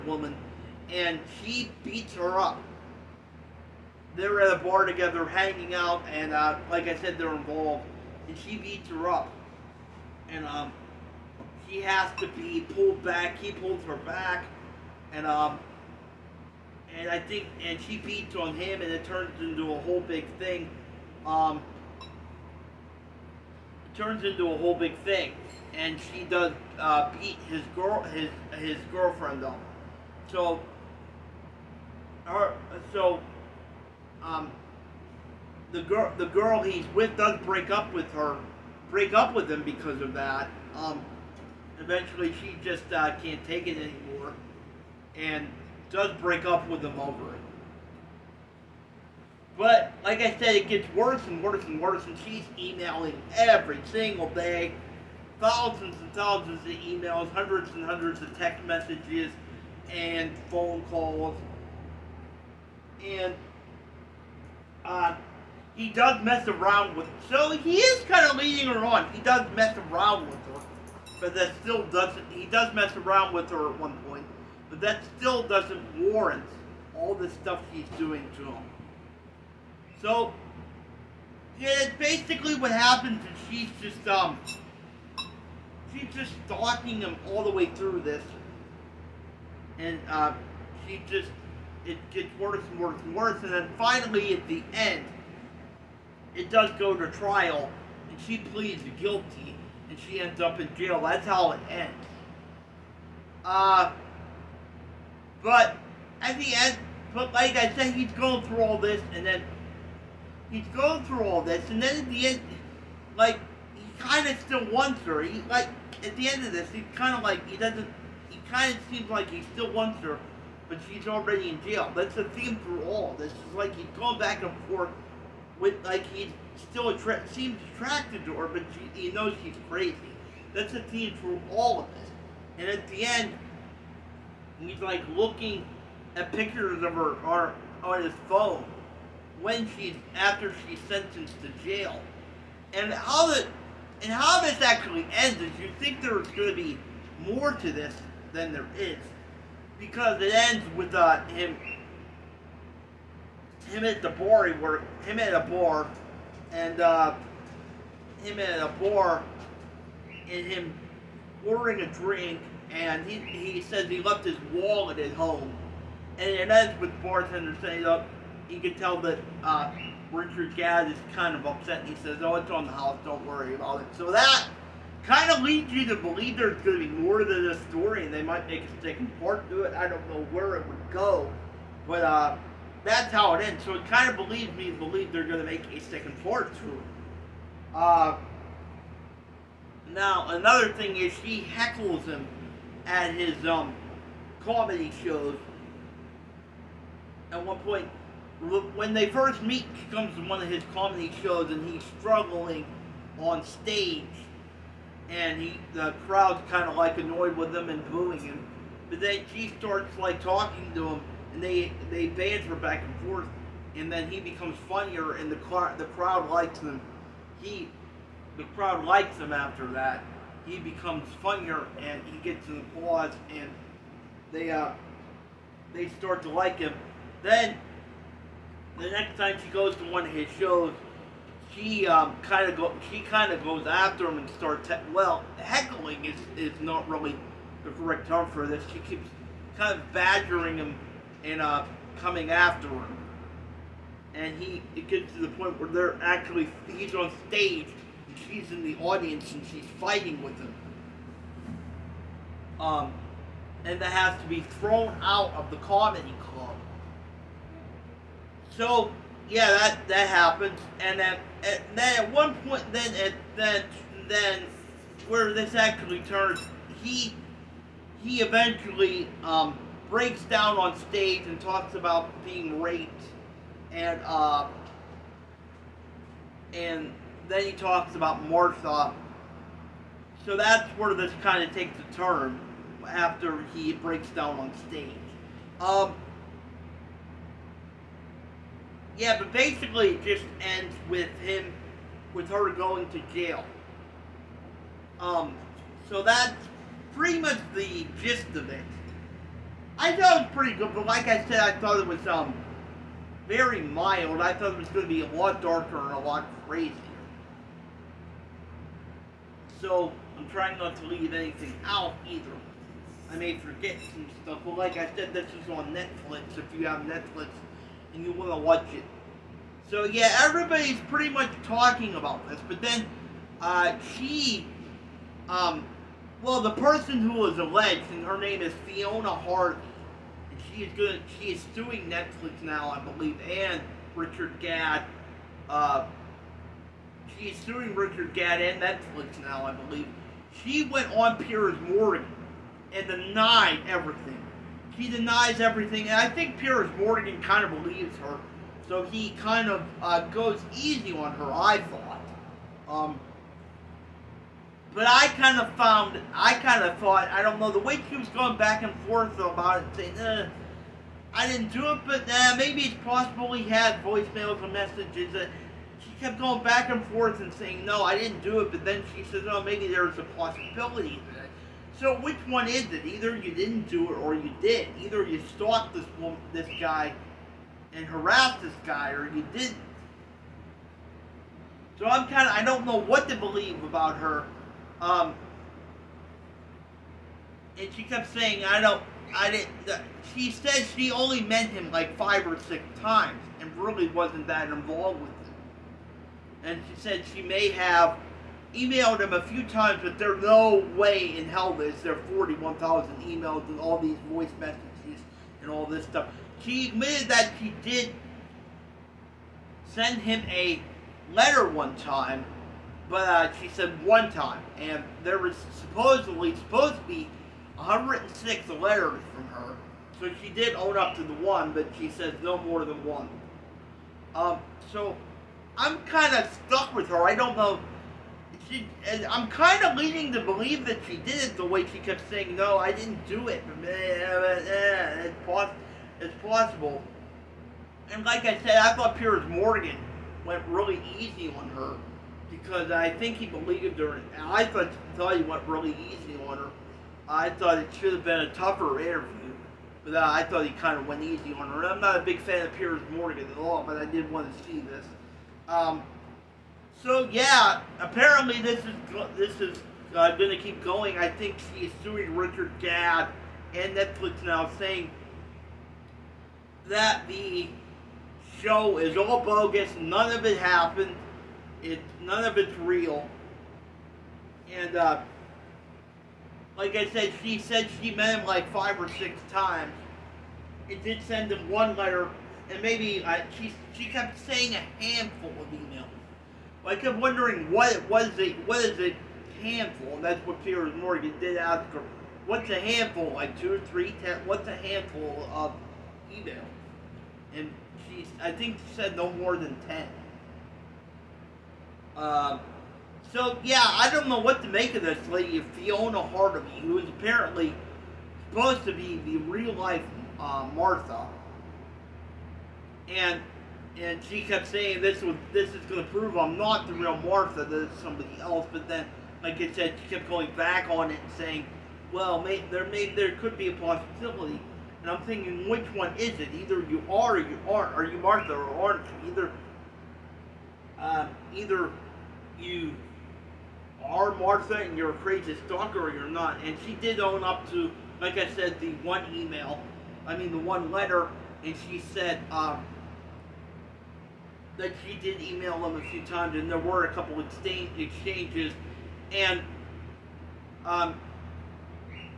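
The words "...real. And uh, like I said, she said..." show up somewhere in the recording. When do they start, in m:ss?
7:52.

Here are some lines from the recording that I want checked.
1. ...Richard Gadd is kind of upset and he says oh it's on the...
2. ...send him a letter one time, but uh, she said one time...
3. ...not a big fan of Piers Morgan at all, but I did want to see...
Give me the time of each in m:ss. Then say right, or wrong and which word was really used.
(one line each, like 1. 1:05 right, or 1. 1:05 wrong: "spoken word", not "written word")
1. 2:50 right
2. 6:49 right
3. 7:31 right.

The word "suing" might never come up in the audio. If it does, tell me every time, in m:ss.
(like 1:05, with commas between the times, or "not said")
5:31, 5:37, 7:41.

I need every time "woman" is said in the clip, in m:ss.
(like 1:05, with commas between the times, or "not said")
0:00, 6:15.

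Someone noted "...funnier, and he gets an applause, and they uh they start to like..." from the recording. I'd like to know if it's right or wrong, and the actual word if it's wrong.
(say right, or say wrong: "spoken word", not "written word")
right.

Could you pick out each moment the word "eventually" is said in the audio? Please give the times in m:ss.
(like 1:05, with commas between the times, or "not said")
0:41, 4:28.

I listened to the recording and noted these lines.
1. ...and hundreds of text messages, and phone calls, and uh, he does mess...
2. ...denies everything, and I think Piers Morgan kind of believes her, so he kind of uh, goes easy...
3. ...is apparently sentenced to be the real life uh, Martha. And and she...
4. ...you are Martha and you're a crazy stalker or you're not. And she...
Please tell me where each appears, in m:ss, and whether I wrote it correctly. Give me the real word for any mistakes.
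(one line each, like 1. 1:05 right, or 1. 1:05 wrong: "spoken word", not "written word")
1. 0:57 right
2. 5:44 right
3. 8:26 wrong: "supposed", not "sentenced"
4. 8:52 right.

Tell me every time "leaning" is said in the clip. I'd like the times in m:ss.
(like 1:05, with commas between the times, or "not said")
7:09.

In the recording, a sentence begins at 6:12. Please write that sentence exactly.
Either you didn't do it or you did.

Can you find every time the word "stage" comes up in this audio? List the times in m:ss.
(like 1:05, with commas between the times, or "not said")
3:23, 4:07, 4:30, 4:44.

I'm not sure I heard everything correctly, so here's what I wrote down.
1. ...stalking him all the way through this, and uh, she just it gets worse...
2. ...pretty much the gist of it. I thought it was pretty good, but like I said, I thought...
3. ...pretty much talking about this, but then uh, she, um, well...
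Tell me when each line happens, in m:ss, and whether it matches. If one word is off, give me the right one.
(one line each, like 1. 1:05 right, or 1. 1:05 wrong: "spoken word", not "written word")
1. 1:26 right
2. 4:56 right
3. 5:20 right.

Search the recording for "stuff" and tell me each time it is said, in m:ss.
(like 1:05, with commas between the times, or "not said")
1:17, 5:14, 6:45.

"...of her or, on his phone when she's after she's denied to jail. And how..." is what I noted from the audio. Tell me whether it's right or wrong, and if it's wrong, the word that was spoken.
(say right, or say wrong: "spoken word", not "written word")
wrong: "sentenced", not "denied".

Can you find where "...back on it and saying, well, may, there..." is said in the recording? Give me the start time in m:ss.
8:40.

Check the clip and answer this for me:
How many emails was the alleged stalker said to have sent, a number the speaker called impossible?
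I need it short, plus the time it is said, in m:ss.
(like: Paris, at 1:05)
41,000, at 6:42.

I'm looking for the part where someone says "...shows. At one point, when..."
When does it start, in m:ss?
3:15.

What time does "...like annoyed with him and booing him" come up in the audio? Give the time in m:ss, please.
3:26.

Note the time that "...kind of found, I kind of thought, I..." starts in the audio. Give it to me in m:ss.
5:55.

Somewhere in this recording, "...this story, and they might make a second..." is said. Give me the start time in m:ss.
2:57.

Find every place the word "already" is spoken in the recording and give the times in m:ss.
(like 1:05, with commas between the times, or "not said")
2:01.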